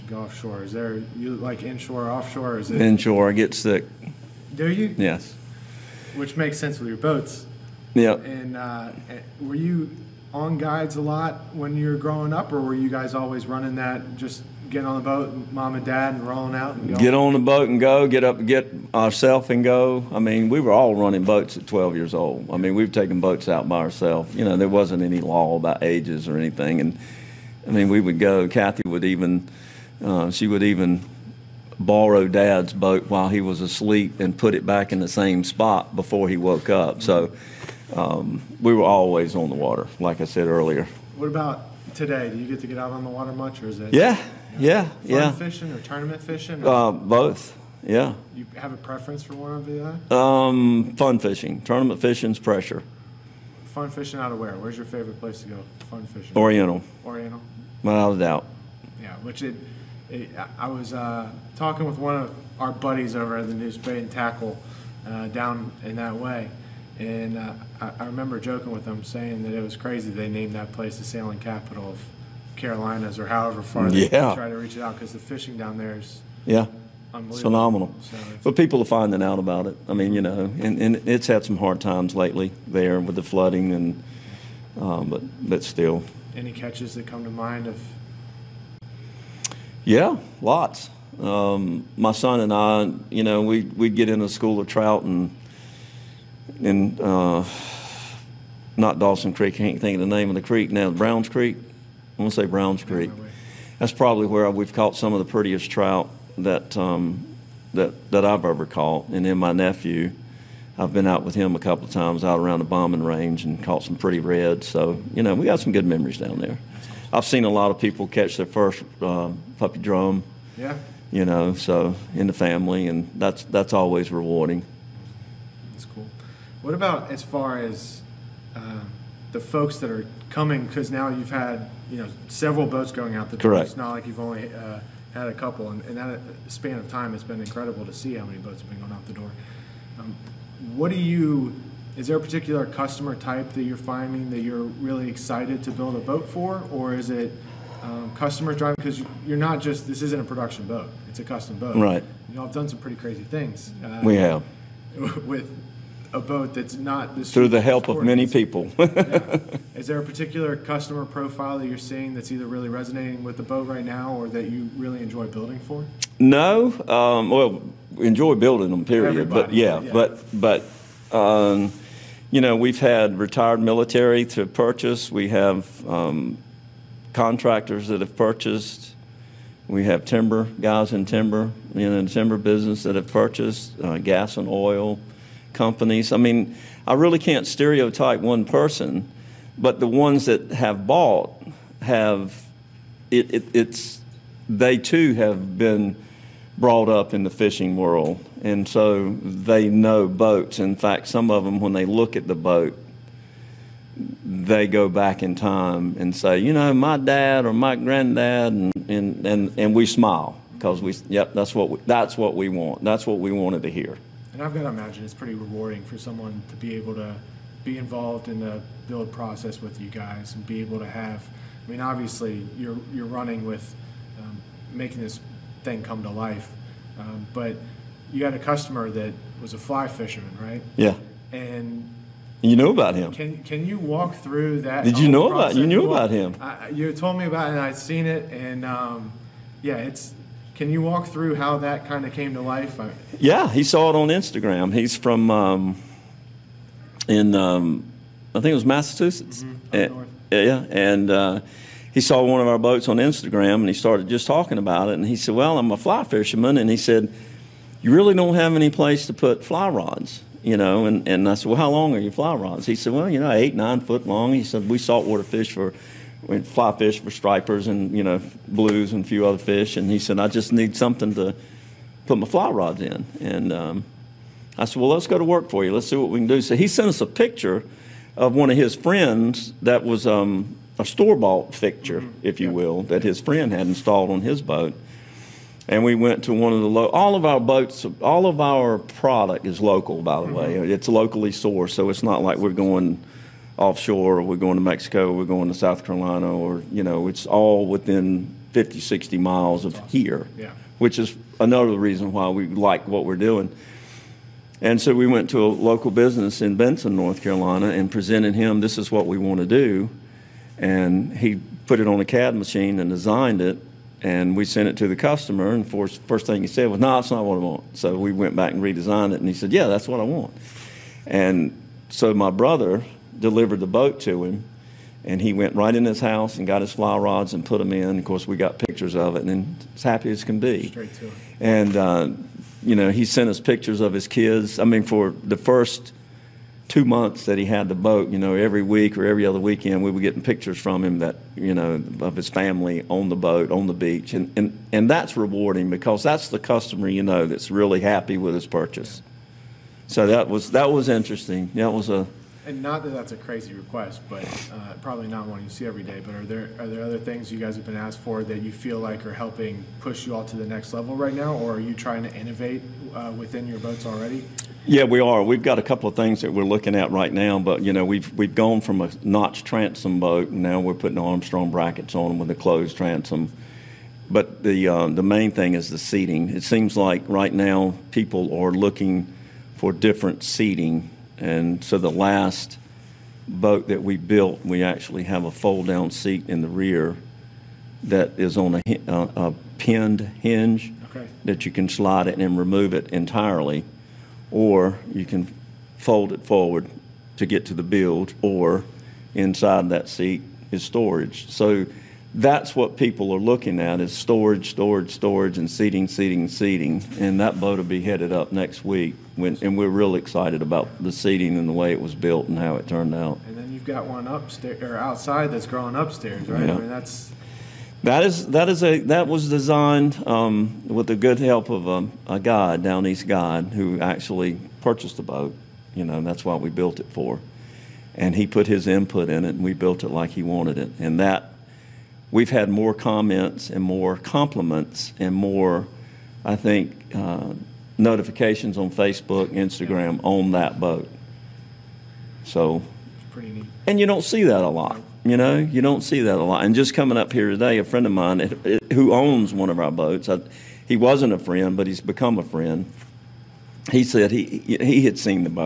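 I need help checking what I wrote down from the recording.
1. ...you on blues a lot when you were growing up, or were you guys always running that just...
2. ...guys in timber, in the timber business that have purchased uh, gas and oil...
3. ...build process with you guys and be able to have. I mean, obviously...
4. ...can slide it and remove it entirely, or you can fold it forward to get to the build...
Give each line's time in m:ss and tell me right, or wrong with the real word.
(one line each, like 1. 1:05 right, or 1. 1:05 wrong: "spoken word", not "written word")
1. 0:09 wrong: "guides", not "blues"
2. 3:00 right
3. 3:38 right
4. 6:31 right.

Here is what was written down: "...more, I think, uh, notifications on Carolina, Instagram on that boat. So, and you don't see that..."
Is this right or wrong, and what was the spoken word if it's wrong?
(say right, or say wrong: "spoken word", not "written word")
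wrong: "Facebook", not "Carolina".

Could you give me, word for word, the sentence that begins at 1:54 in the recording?
So you know we got some good memories down there.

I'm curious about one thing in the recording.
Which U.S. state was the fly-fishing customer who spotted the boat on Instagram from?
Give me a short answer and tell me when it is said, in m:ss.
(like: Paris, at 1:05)
Massachusetts, at 4:08.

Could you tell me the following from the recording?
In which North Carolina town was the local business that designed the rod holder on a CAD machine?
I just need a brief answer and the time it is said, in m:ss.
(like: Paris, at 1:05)
Benson, at 5:06.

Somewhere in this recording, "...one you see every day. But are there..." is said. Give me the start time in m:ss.
5:55.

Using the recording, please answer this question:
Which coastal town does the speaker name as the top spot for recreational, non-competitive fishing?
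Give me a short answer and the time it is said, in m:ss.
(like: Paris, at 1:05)
Oriental, at 0:57.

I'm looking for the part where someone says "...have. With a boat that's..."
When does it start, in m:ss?
2:34.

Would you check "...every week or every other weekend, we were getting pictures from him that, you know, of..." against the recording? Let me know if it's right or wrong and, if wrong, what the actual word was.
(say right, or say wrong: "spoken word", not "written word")
right.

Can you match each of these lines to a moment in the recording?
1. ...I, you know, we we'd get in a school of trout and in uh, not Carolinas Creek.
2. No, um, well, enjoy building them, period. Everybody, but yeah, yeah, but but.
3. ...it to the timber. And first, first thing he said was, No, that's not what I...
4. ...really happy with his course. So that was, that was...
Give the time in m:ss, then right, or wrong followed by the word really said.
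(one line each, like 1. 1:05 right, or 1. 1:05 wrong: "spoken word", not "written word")
1. 1:32 wrong: "Dawson", not "Carolinas"
2. 2:46 right
3. 5:14 wrong: "customer", not "timber"
4. 5:47 wrong: "purchase", not "course".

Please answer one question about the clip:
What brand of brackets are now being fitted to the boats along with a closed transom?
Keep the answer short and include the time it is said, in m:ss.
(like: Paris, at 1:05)
Armstrong, at 6:10.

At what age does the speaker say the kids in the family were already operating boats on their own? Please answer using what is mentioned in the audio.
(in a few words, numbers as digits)
12.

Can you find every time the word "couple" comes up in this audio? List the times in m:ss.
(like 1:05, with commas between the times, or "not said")
1:51, 2:15, 6:05.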